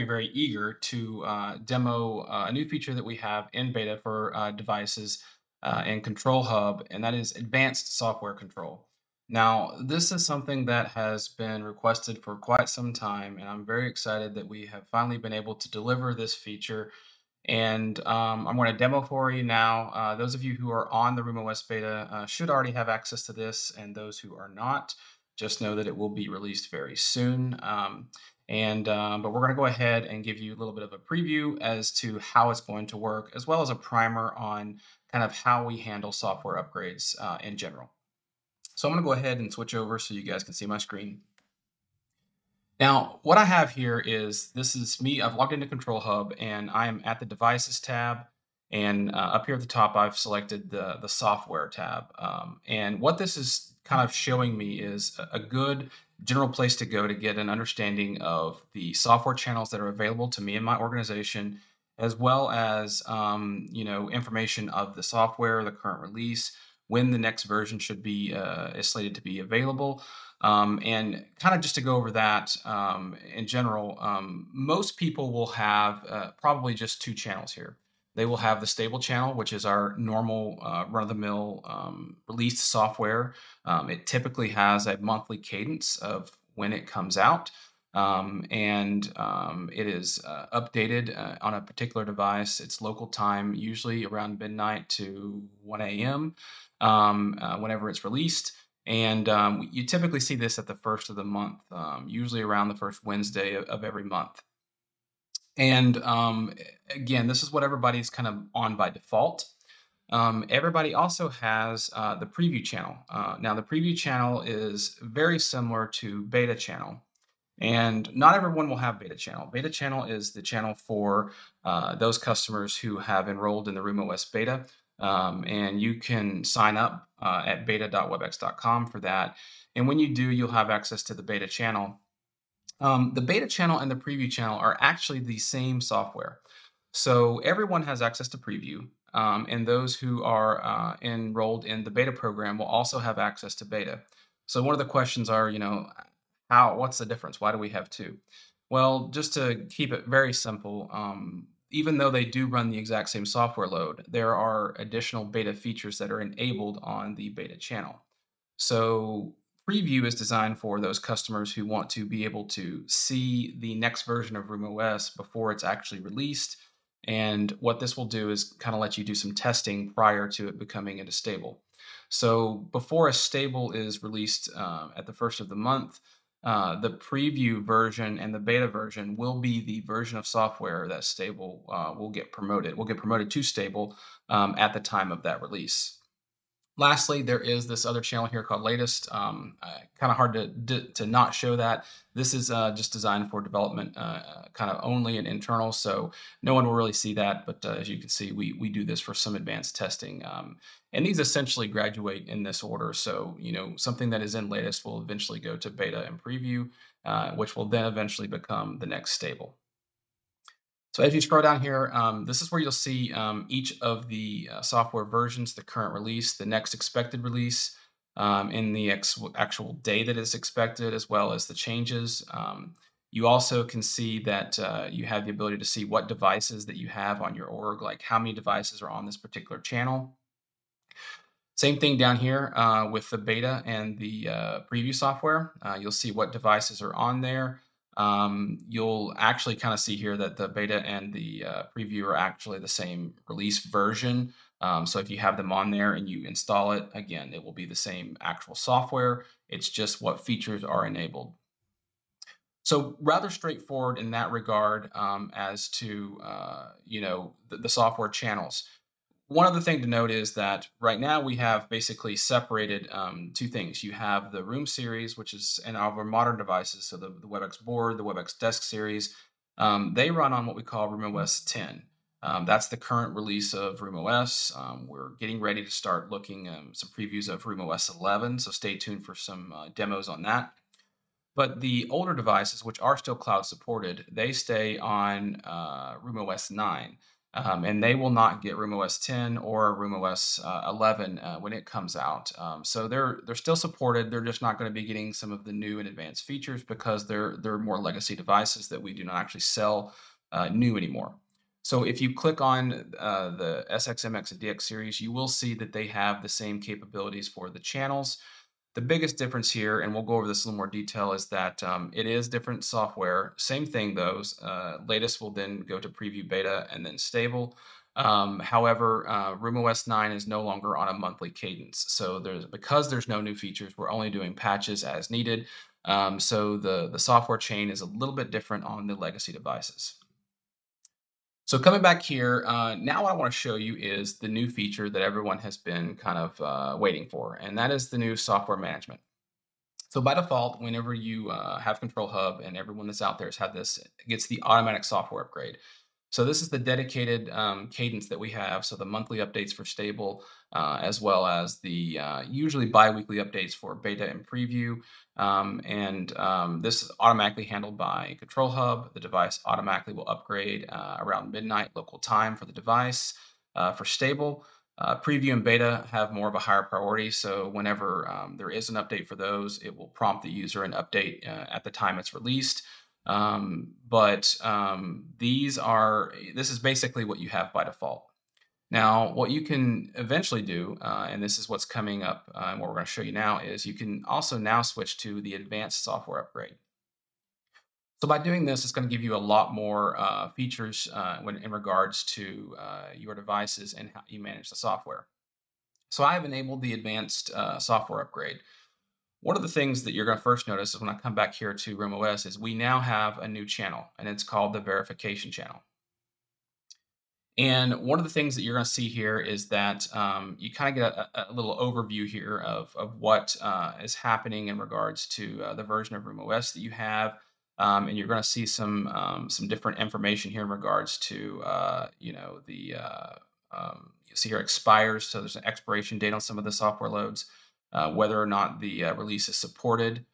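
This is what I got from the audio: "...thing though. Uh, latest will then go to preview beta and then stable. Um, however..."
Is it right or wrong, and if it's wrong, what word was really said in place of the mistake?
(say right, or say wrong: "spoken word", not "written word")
right.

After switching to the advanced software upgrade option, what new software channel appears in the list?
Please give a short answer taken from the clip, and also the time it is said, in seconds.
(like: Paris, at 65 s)
verification channel, at 404 s.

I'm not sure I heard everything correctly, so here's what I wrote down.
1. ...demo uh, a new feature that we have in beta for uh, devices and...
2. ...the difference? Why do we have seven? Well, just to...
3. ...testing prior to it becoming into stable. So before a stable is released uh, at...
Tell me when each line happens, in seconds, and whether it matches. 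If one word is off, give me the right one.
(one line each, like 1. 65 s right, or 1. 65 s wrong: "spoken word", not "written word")
1. 1 s right
2. 146 s wrong: "two", not "seven"
3. 169 s right.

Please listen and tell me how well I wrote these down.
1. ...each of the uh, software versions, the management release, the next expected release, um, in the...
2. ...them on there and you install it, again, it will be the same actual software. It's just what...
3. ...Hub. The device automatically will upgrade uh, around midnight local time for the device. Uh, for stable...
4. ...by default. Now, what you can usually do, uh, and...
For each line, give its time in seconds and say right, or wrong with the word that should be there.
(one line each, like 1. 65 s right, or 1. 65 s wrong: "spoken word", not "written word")
1. 213 s wrong: "current", not "management"
2. 245 s right
3. 358 s right
4. 377 s wrong: "eventually", not "usually".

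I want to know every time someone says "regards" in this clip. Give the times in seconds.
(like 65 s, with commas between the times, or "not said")
254 s, 391 s, 414 s, 420 s.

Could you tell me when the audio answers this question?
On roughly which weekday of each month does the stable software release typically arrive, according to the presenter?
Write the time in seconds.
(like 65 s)
102 s.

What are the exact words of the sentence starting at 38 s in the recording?
So I'm going to go ahead and switch over so you guys can see my screen.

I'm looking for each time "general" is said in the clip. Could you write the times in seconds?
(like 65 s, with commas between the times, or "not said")
37 s, 56 s, 73 s.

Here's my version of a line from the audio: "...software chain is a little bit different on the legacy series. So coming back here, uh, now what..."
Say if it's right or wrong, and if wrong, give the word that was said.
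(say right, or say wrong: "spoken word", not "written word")
wrong: "devices", not "series".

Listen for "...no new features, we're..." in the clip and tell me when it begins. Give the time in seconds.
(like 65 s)
323 s.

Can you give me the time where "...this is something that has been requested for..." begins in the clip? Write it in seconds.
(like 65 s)
9 s.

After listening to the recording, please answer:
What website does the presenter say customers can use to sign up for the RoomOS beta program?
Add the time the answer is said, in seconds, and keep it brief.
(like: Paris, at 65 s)
beta.webex.com, at 127 s.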